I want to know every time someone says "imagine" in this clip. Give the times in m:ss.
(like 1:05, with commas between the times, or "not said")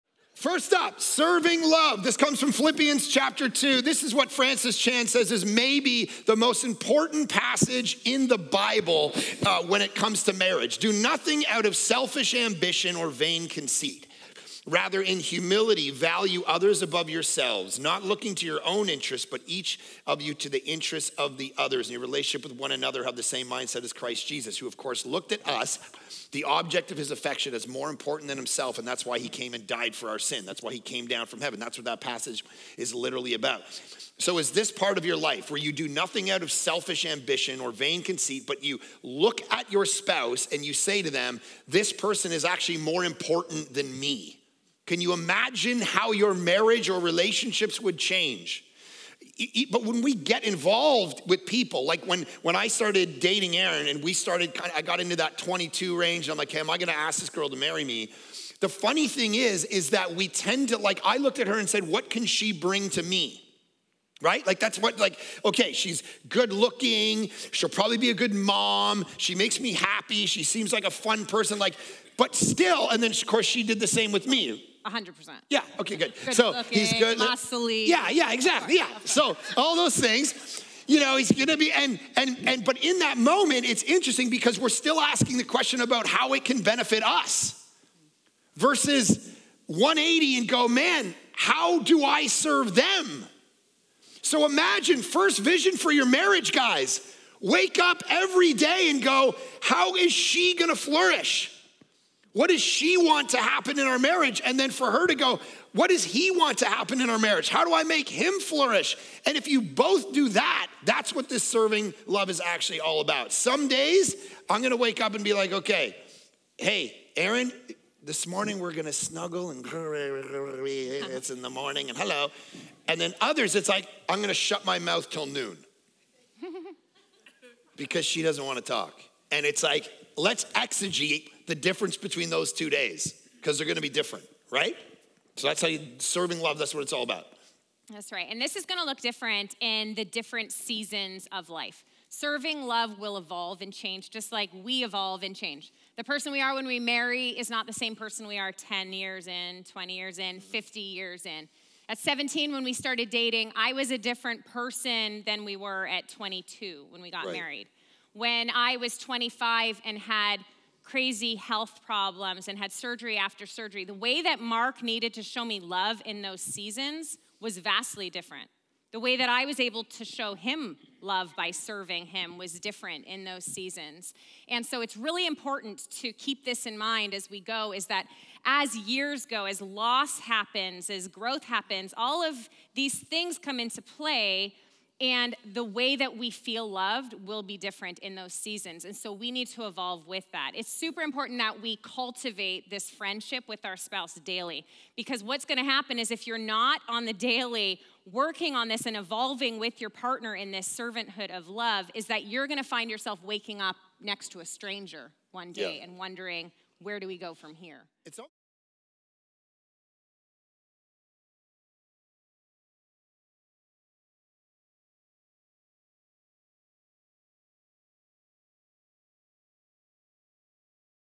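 0:45, 1:34.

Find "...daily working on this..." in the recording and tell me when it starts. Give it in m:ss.
3:17.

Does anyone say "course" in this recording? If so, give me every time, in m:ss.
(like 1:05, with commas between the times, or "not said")
0:24, 1:13.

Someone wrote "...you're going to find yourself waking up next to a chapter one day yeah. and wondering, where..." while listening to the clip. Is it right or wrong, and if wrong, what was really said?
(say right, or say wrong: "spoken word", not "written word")
wrong: "stranger", not "chapter".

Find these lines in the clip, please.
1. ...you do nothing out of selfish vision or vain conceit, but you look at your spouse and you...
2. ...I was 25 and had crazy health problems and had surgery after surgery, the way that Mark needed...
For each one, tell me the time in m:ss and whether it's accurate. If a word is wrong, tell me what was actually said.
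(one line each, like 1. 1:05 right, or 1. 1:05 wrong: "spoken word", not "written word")
1. 0:35 wrong: "ambition", not "vision"
2. 2:38 right.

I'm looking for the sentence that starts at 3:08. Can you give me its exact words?
And so we need to evolve with that.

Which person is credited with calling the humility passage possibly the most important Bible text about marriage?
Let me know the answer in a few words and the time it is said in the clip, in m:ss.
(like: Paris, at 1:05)
Francis Chan, at 0:04.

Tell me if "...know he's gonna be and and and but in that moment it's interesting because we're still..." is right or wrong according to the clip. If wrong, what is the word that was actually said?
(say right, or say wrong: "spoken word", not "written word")
right.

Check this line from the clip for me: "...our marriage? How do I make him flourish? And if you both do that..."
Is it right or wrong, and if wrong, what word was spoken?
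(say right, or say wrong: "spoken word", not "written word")
right.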